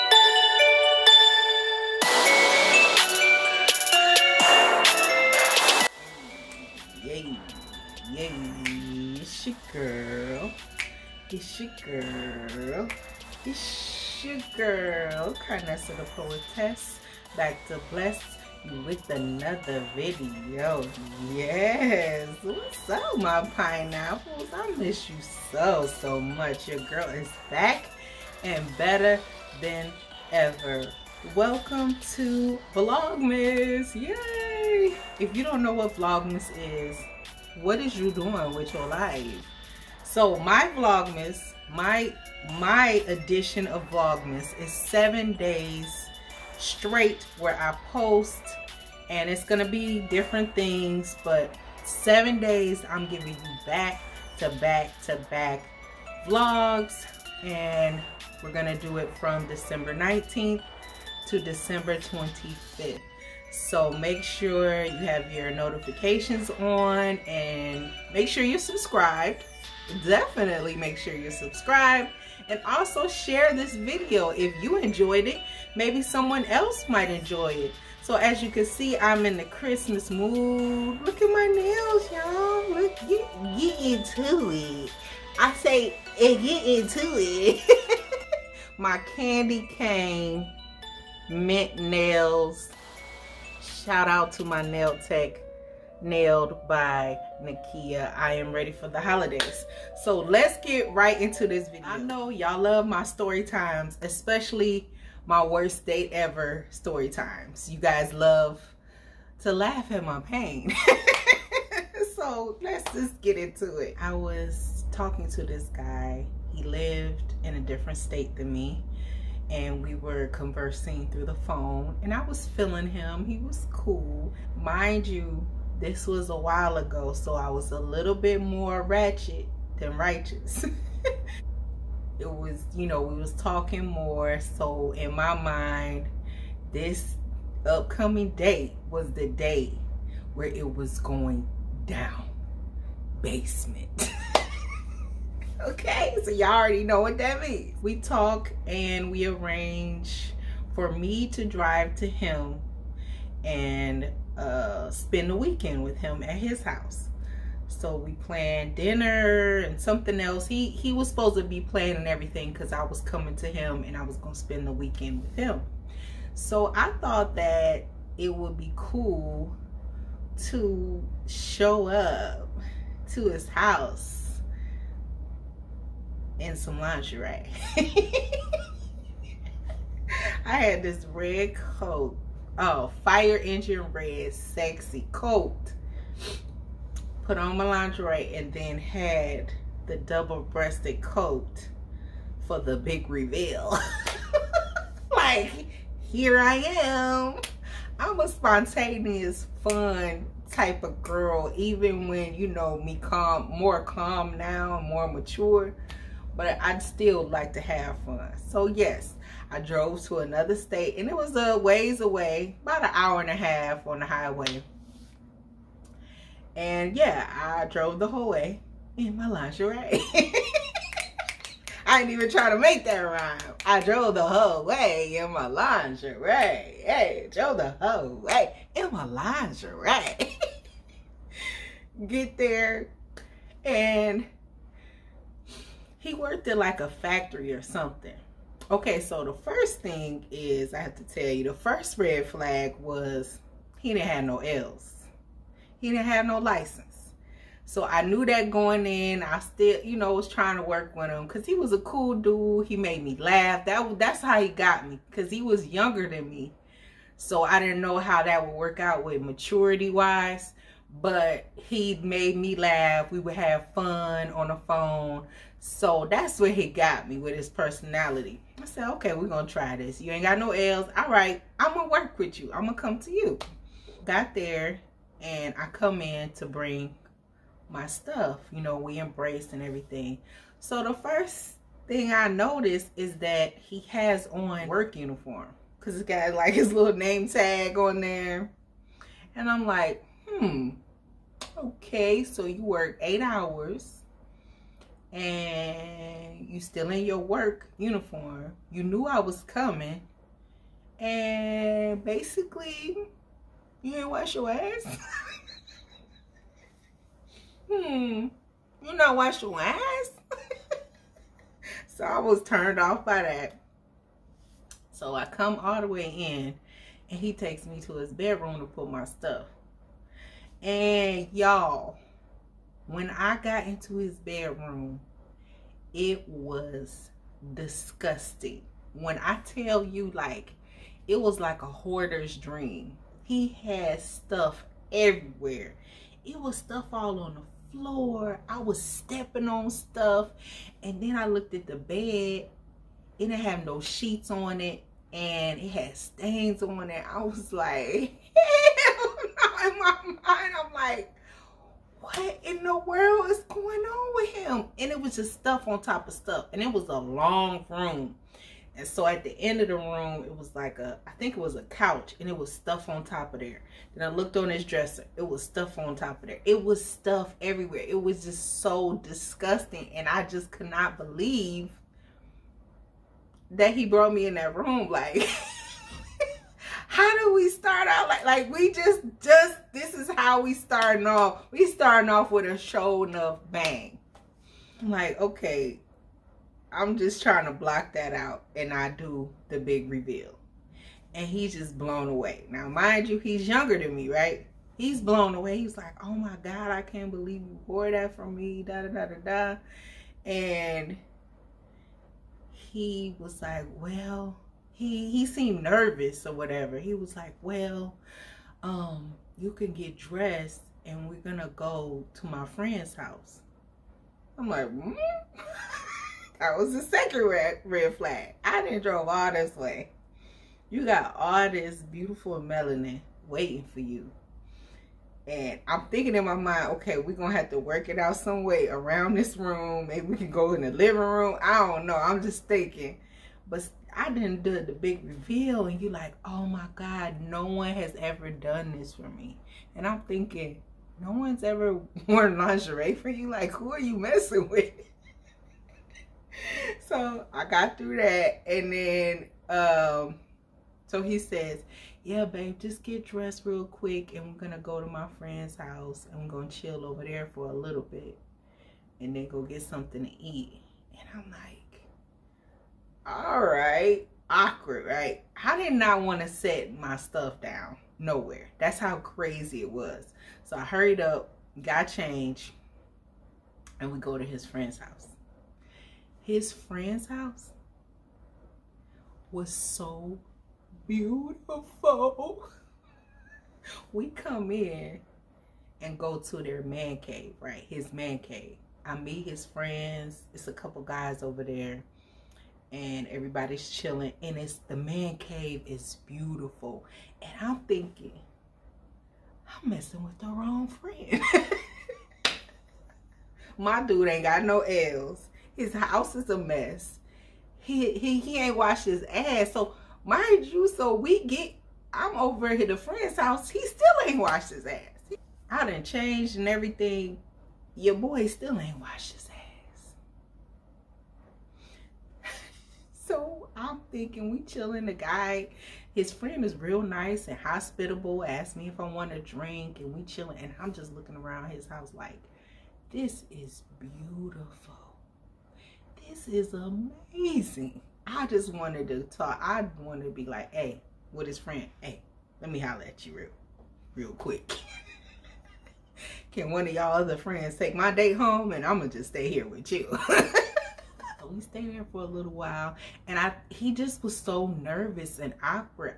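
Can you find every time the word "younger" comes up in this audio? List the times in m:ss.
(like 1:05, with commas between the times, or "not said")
4:15, 6:33.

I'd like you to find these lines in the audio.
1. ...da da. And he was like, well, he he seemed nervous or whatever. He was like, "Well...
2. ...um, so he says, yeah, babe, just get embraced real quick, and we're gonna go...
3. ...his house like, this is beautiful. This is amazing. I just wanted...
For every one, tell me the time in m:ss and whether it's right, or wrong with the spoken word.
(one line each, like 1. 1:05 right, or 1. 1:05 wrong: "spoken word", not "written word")
1. 6:39 right
2. 7:29 wrong: "dressed", not "embraced"
3. 8:51 right.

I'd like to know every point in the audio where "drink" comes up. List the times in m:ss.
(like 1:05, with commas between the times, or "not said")
8:49.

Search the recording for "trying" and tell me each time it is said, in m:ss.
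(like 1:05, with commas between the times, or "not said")
4:10, 6:27.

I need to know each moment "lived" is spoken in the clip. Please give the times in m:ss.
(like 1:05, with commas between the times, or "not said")
1:56.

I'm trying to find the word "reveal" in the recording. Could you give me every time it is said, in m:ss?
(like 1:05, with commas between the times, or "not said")
3:13, 6:29, 7:15.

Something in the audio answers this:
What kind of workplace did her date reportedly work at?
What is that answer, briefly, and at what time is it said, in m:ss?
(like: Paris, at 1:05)
a factory, at 3:56.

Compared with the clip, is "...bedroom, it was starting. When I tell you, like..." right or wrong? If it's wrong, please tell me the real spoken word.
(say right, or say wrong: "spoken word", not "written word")
wrong: "disgusting", not "starting".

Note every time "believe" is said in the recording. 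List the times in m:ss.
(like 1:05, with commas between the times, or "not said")
6:10, 6:37.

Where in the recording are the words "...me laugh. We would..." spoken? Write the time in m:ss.
4:22.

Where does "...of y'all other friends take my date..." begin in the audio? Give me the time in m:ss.
9:06.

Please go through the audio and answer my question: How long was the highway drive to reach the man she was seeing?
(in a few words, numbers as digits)
an hour and a half.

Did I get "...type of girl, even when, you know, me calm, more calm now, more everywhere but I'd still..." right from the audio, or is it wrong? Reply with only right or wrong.
wrong.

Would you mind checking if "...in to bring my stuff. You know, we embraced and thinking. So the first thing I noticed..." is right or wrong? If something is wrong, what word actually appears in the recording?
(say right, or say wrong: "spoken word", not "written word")
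wrong: "everything", not "thinking".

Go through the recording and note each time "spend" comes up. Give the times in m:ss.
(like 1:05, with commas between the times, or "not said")
2:34, 2:44.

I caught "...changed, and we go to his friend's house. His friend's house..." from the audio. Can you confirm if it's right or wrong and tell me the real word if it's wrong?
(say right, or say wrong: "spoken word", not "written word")
right.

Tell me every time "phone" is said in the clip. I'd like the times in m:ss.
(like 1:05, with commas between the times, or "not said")
2:01, 4:24.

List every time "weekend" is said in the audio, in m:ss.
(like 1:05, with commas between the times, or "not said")
2:35, 2:44.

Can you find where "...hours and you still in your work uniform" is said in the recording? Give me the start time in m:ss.
4:53.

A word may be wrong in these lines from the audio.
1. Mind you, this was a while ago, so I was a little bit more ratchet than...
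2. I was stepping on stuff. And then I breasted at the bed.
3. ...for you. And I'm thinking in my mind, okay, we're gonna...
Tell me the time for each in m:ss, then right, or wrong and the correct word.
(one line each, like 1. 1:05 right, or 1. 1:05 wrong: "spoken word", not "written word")
1. 2:04 right
2. 5:38 wrong: "looked", not "breasted"
3. 7:03 right.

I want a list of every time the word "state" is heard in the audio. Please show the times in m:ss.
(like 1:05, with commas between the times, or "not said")
1:57, 3:30.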